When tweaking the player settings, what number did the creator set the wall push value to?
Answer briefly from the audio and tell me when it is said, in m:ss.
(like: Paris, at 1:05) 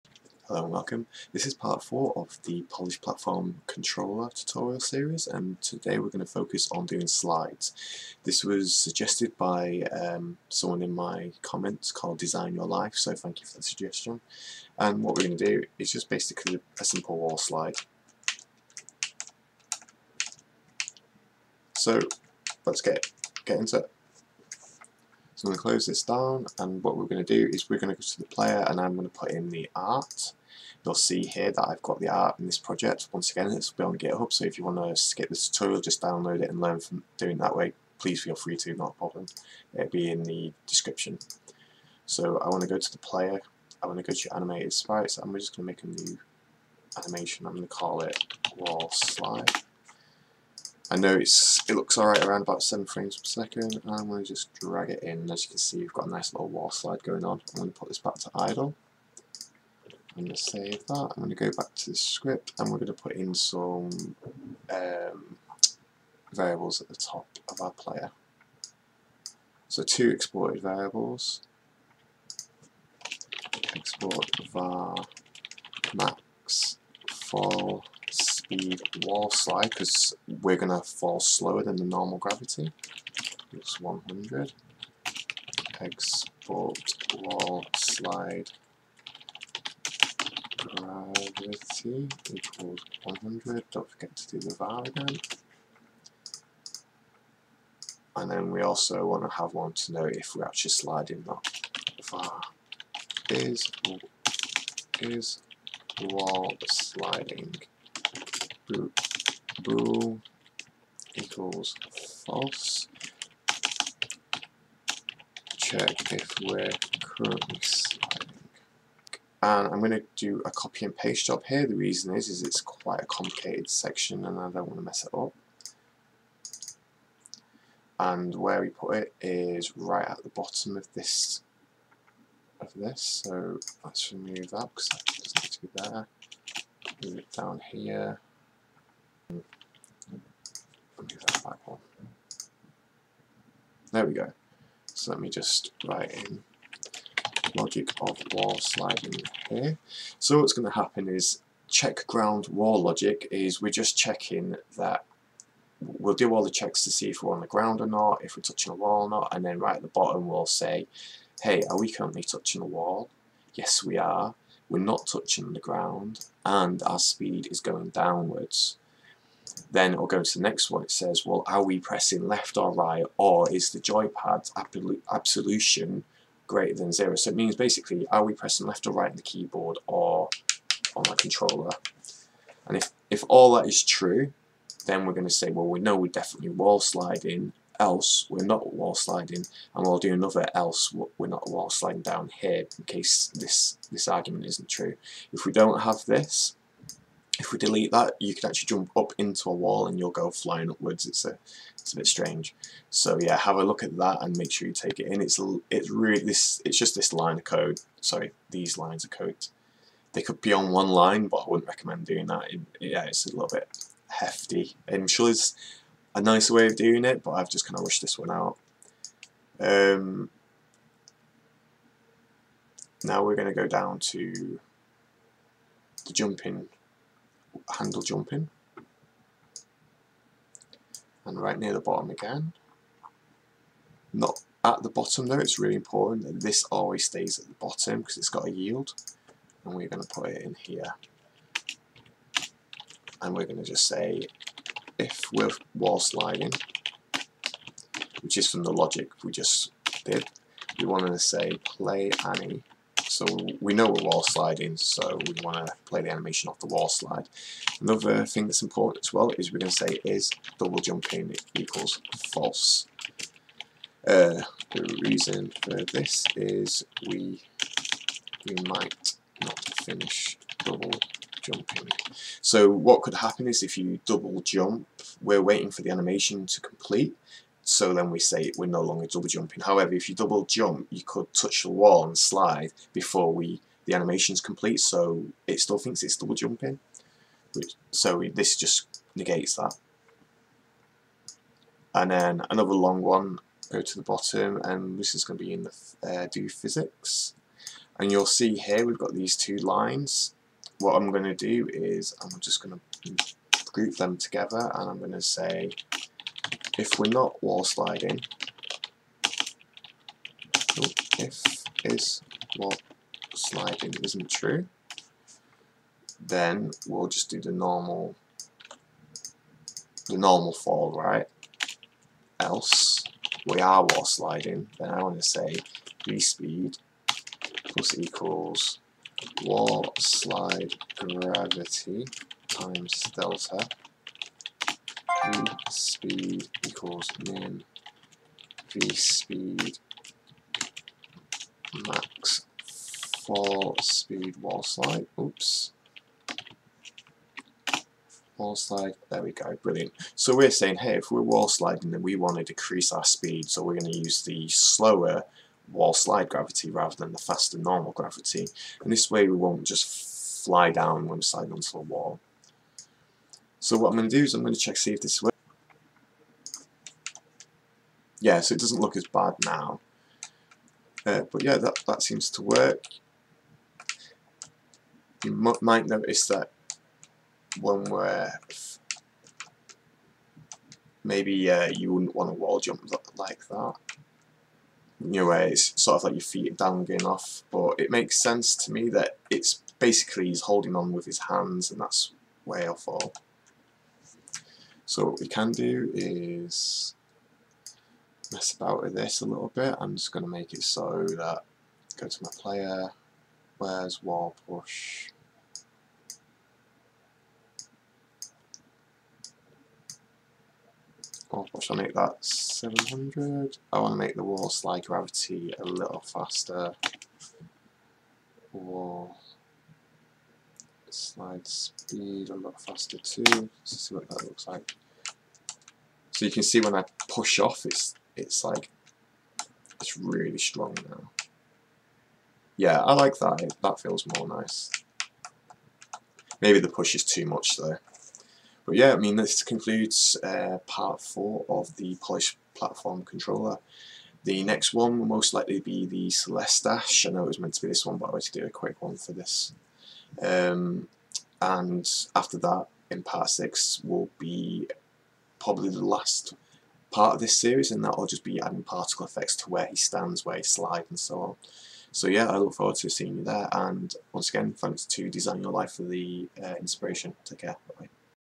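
700, at 6:52.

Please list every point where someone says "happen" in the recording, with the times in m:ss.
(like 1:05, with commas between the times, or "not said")
2:30, 4:33.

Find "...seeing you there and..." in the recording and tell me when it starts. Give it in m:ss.
7:42.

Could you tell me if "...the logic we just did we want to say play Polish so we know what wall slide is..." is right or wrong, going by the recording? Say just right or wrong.
wrong.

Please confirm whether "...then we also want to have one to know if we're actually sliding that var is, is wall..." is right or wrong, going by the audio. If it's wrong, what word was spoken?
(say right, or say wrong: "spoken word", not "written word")
right.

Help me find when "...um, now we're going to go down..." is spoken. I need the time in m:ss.
3:39.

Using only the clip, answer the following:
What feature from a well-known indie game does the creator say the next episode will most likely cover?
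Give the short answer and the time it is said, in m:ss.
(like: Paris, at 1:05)
Celeste dash, at 7:26.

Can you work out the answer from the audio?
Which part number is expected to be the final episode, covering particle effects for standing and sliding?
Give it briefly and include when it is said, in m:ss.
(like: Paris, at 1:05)
6, at 7:33.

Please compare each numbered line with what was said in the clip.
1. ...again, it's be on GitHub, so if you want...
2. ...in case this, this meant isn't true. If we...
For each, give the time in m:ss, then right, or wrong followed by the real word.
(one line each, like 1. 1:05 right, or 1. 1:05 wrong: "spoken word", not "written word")
1. 0:33 right
2. 3:12 wrong: "argument", not "meant".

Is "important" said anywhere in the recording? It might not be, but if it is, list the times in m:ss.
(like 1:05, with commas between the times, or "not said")
3:55, 4:18.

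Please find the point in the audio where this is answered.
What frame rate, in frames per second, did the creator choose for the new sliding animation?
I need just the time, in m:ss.
0:52.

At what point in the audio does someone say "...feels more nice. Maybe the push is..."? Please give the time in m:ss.
7:13.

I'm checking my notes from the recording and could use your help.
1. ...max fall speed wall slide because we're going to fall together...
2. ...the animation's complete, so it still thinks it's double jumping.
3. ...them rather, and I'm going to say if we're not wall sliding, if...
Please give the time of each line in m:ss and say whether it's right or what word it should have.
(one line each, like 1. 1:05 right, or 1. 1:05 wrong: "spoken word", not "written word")
1. 1:15 wrong: "slower", not "together"
2. 4:43 right
3. 5:03 wrong: "together", not "rather".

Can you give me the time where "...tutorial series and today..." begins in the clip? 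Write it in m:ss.
0:04.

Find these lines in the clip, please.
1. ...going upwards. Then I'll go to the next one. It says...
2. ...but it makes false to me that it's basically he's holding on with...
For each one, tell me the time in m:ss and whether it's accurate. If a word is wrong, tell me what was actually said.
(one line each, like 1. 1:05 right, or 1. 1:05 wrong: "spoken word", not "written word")
1. 2:47 wrong: "downwards", not "upwards"
2. 6:27 wrong: "sense", not "false".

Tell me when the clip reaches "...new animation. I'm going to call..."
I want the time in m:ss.
0:46.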